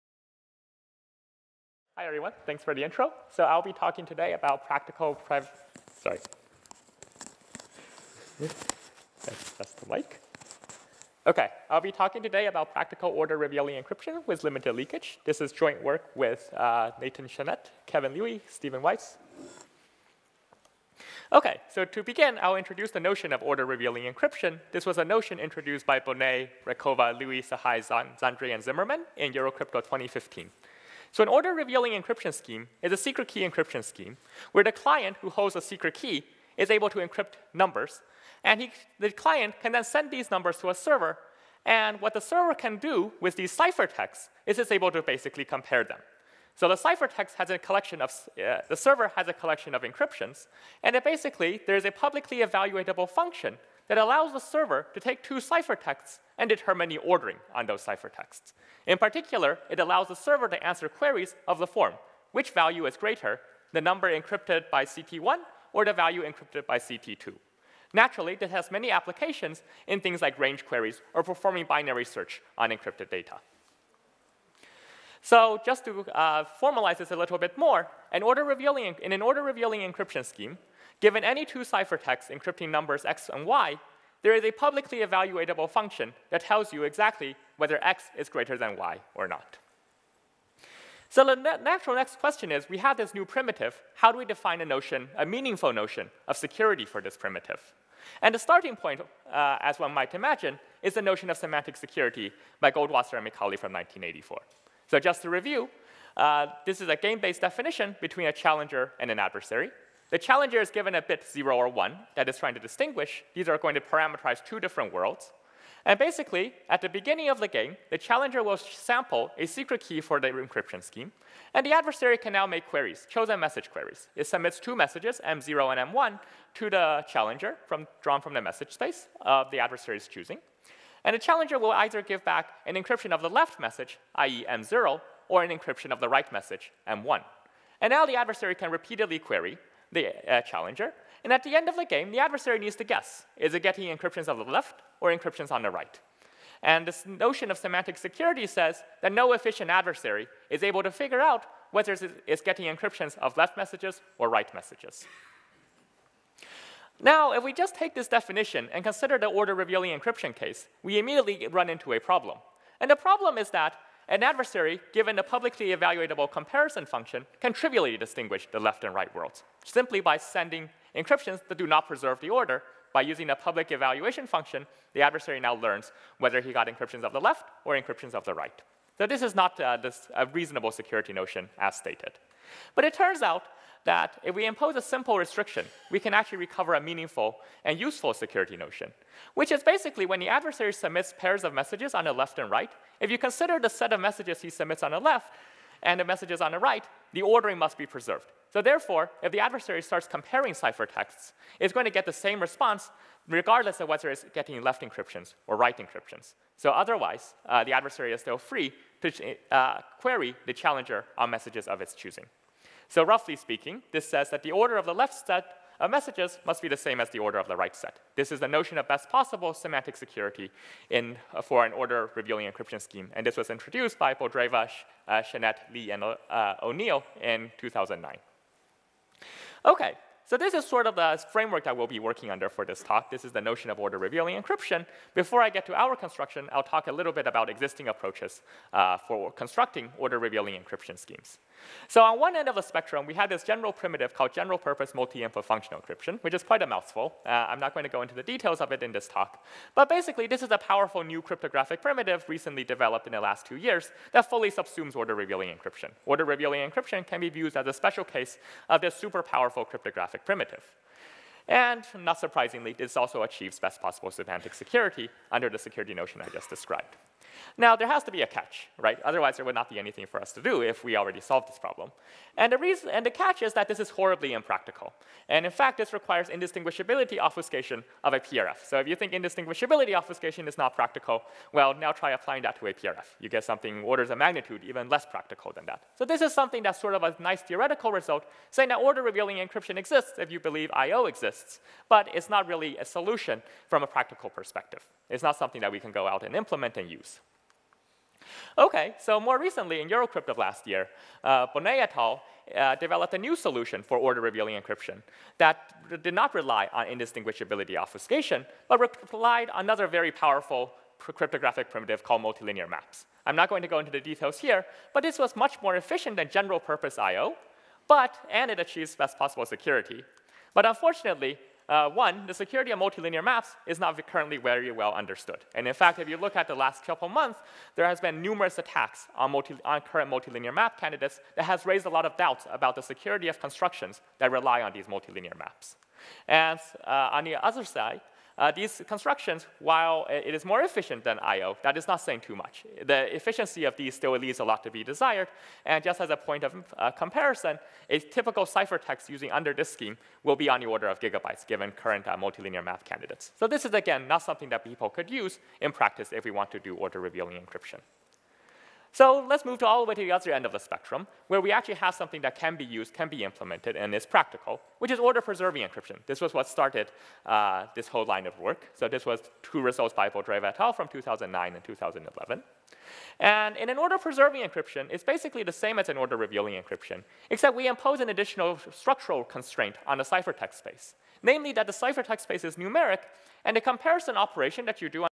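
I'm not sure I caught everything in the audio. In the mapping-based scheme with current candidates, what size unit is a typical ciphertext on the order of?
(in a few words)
gigabytes.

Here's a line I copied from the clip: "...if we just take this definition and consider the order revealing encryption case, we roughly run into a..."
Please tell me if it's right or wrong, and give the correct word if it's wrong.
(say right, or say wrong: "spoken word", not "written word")
wrong: "immediately", not "roughly".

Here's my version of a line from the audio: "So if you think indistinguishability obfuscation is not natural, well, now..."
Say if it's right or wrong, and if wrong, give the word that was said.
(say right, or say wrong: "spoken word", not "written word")
wrong: "practical", not "natural".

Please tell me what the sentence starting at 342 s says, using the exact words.
The efficiency of these still leaves a lot to be desired.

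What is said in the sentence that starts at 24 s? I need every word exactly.
This was a notion introduced by Boneh, Raykova, Lewi, Sahai, Zhandry, and Zimmerman in Eurocrypt 2015.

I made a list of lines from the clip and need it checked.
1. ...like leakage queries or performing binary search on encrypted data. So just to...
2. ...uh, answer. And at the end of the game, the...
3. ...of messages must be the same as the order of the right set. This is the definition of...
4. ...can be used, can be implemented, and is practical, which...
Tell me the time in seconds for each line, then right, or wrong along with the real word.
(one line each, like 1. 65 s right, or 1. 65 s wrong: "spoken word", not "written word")
1. 70 s wrong: "range", not "leakage"
2. 140 s wrong: "challenger", not "answer"
3. 215 s wrong: "notion", not "definition"
4. 362 s right.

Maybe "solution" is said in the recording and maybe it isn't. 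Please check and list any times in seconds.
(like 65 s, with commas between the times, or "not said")
292 s, 303 s.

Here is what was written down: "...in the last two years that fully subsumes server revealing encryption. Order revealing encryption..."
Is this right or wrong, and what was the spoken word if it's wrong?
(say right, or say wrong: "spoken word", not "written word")
wrong: "order", not "server".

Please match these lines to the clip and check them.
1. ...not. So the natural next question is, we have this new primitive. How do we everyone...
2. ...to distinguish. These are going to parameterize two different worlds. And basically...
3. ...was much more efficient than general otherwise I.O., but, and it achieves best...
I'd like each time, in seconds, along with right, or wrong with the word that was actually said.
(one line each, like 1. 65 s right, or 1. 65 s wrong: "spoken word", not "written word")
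1. 89 s wrong: "define", not "everyone"
2. 112 s right
3. 315 s wrong: "purpose", not "otherwise".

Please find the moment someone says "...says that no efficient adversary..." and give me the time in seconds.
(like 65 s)
148 s.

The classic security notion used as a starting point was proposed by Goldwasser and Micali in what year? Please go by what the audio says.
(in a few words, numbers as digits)
1984.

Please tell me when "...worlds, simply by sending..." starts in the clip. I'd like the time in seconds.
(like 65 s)
169 s.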